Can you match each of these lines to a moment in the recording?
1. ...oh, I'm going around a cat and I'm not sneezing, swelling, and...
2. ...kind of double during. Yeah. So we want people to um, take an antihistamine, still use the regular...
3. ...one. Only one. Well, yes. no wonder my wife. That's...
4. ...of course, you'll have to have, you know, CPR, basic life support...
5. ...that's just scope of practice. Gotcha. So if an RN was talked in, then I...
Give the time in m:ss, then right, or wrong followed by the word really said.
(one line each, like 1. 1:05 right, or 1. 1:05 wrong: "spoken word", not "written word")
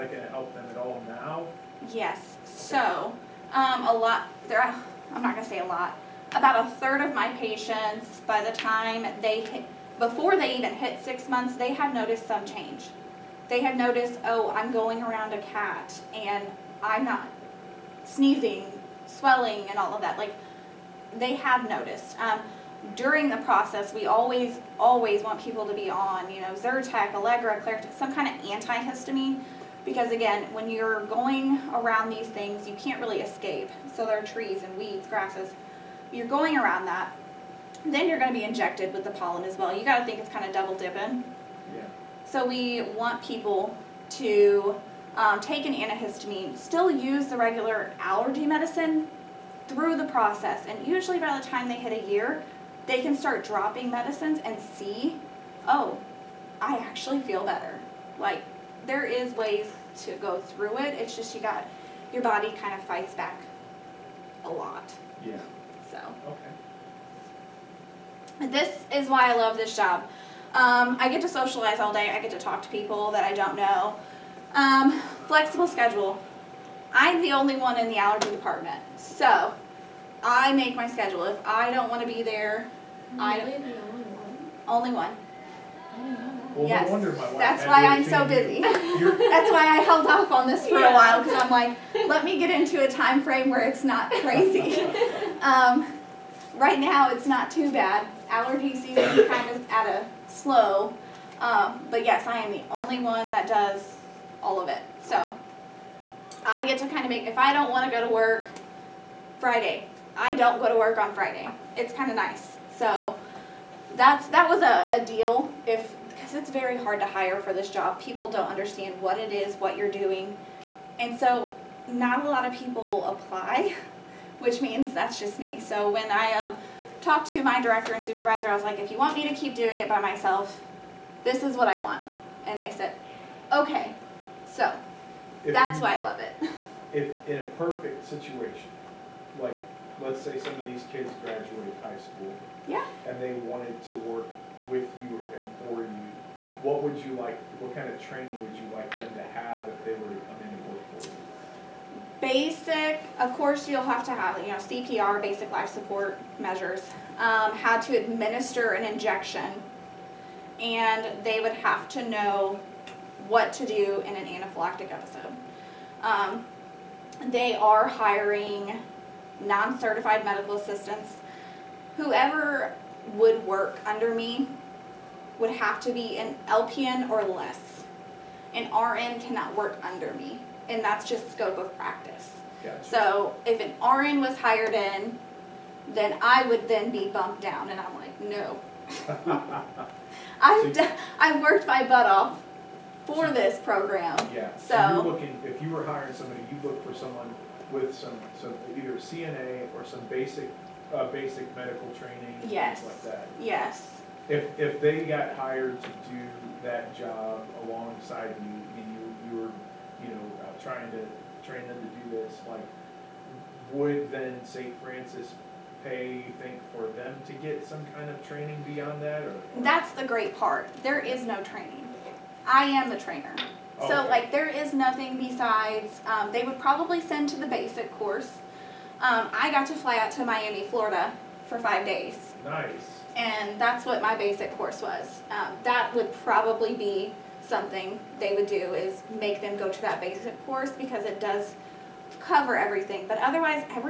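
1. 0:14 right
2. 0:40 wrong: "dipping", not "during"
3. 1:24 right
4. 2:33 right
5. 3:00 wrong: "hired", not "talked".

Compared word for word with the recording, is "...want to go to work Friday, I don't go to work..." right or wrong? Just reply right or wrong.
right.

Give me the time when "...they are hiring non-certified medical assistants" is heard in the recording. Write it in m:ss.
2:47.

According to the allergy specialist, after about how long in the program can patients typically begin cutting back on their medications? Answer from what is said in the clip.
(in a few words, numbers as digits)
a year.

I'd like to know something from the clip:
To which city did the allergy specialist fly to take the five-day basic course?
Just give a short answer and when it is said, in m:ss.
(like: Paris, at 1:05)
Miami, Florida, at 3:50.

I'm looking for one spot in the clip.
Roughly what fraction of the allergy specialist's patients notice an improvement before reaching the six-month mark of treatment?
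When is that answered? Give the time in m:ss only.
0:06.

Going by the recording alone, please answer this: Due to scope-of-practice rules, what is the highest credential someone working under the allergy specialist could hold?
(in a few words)
LPN.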